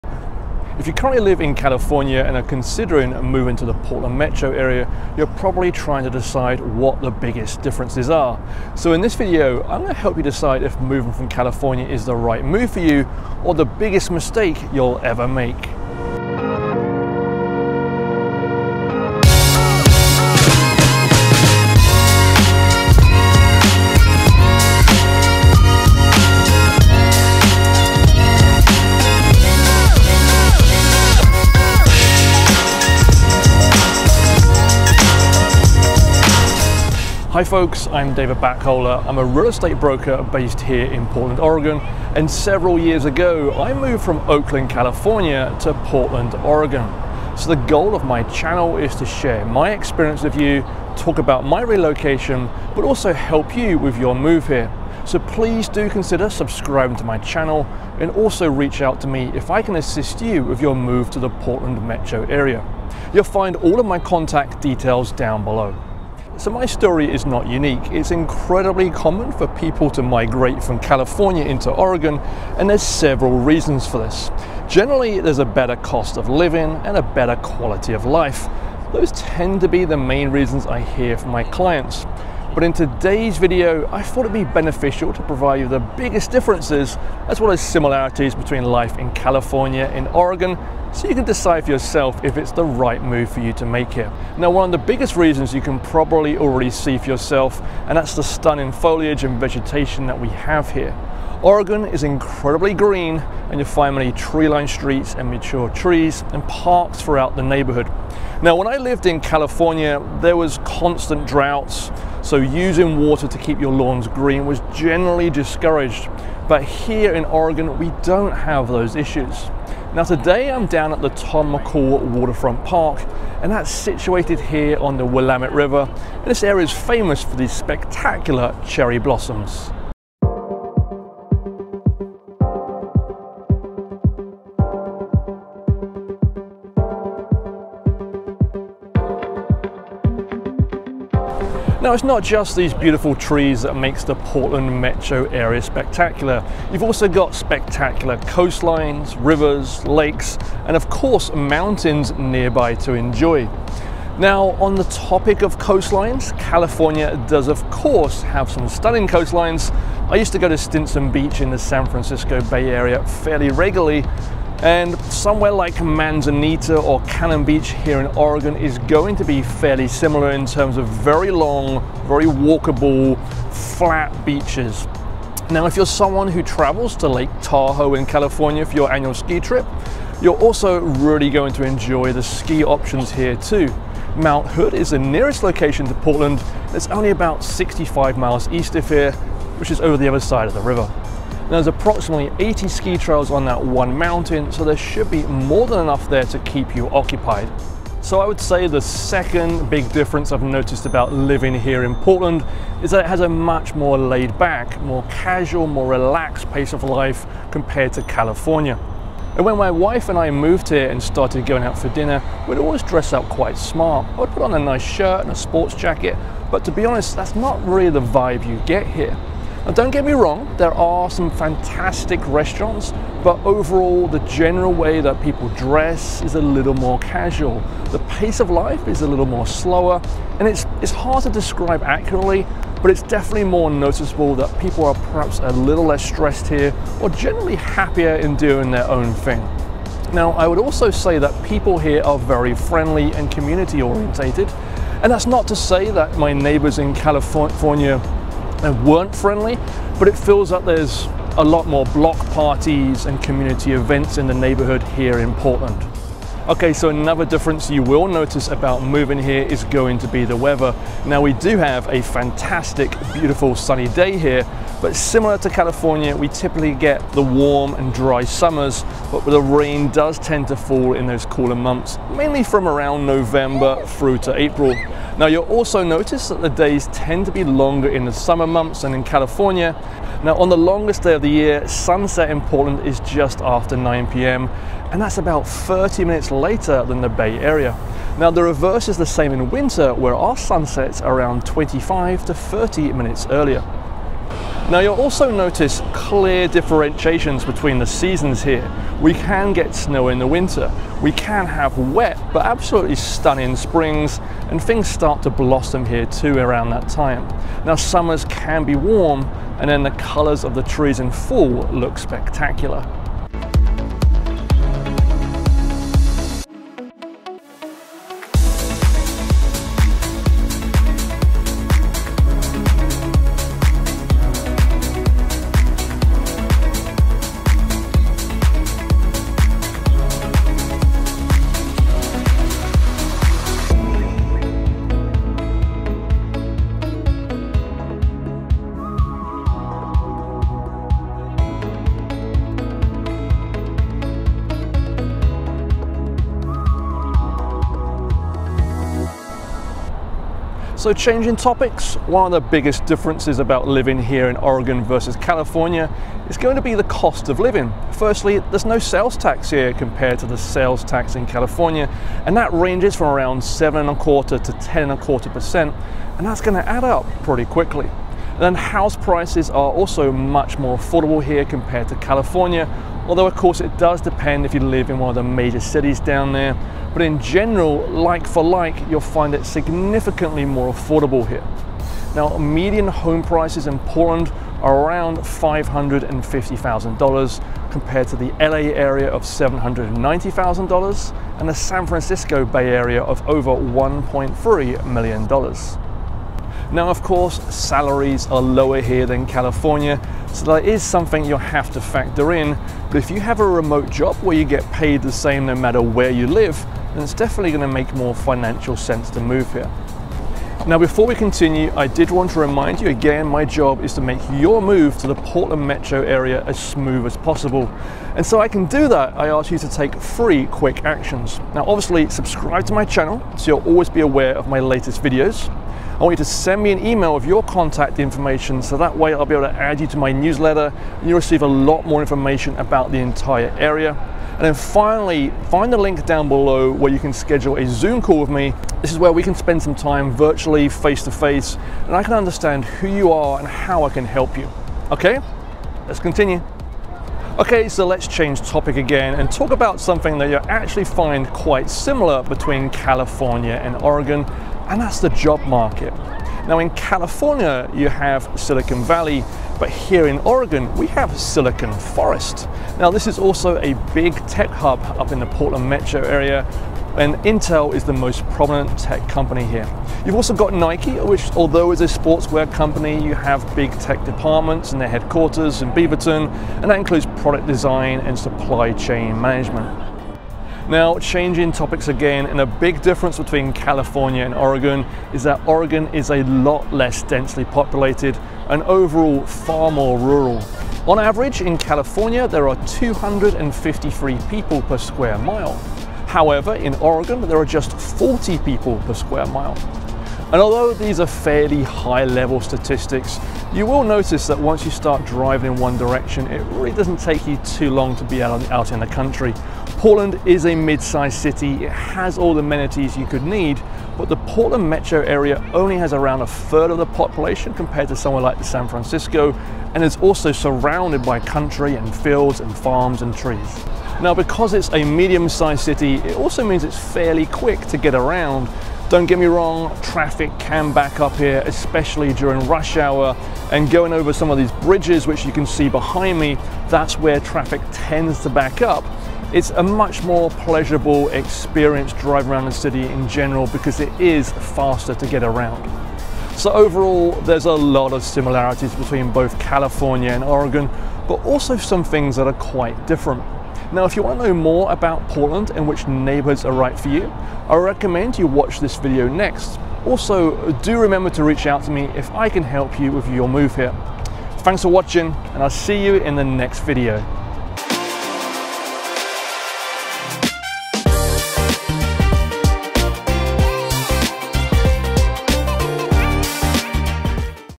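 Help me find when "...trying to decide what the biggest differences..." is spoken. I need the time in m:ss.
0:05.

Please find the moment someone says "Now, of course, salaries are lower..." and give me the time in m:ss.
6:36.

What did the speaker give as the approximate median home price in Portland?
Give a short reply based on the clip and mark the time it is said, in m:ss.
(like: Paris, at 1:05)
$550,000, at 6:25.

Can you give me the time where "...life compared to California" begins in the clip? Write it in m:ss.
3:26.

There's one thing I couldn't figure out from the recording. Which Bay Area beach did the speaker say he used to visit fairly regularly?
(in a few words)
Stinson Beach.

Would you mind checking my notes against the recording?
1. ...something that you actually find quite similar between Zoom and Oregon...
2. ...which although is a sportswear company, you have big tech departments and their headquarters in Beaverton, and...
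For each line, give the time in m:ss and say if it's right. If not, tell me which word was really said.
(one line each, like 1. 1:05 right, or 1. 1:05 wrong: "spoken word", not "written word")
1. 7:29 wrong: "California", not "Zoom"
2. 7:50 right.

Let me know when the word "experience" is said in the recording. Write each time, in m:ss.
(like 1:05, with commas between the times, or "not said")
0:49, 9:01.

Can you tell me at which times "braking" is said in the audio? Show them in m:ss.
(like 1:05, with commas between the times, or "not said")
not said.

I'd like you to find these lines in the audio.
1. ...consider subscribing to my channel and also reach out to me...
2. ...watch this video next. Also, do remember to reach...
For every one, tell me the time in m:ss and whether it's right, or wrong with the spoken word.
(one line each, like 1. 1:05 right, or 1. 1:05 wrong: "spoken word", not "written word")
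1. 0:55 right
2. 9:18 right.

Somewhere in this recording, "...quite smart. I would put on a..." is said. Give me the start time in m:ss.
3:33.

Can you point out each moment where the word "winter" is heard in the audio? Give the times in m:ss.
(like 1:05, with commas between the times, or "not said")
4:49, 5:00.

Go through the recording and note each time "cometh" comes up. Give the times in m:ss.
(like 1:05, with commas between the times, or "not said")
not said.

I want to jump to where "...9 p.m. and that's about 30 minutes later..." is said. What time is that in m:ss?
4:43.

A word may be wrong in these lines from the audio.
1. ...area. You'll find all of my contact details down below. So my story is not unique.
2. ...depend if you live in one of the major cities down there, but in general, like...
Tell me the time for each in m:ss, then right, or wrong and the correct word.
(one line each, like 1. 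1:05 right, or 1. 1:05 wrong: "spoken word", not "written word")
1. 1:02 right
2. 6:13 right.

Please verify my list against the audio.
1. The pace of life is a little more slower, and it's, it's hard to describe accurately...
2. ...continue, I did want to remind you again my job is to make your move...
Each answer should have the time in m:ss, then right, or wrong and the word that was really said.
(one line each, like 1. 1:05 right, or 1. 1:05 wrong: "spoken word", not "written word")
1. 3:47 right
2. 6:51 right.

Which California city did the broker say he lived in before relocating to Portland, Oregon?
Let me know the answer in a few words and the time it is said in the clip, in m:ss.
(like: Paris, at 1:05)
Oakland, at 0:44.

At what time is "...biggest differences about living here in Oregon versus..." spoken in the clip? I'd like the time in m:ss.
5:52.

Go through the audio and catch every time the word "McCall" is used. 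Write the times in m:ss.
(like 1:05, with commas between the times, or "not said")
2:01.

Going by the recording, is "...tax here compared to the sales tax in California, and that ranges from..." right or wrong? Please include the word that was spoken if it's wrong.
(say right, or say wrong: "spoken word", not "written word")
right.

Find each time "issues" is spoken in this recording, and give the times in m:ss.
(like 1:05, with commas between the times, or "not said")
1:58.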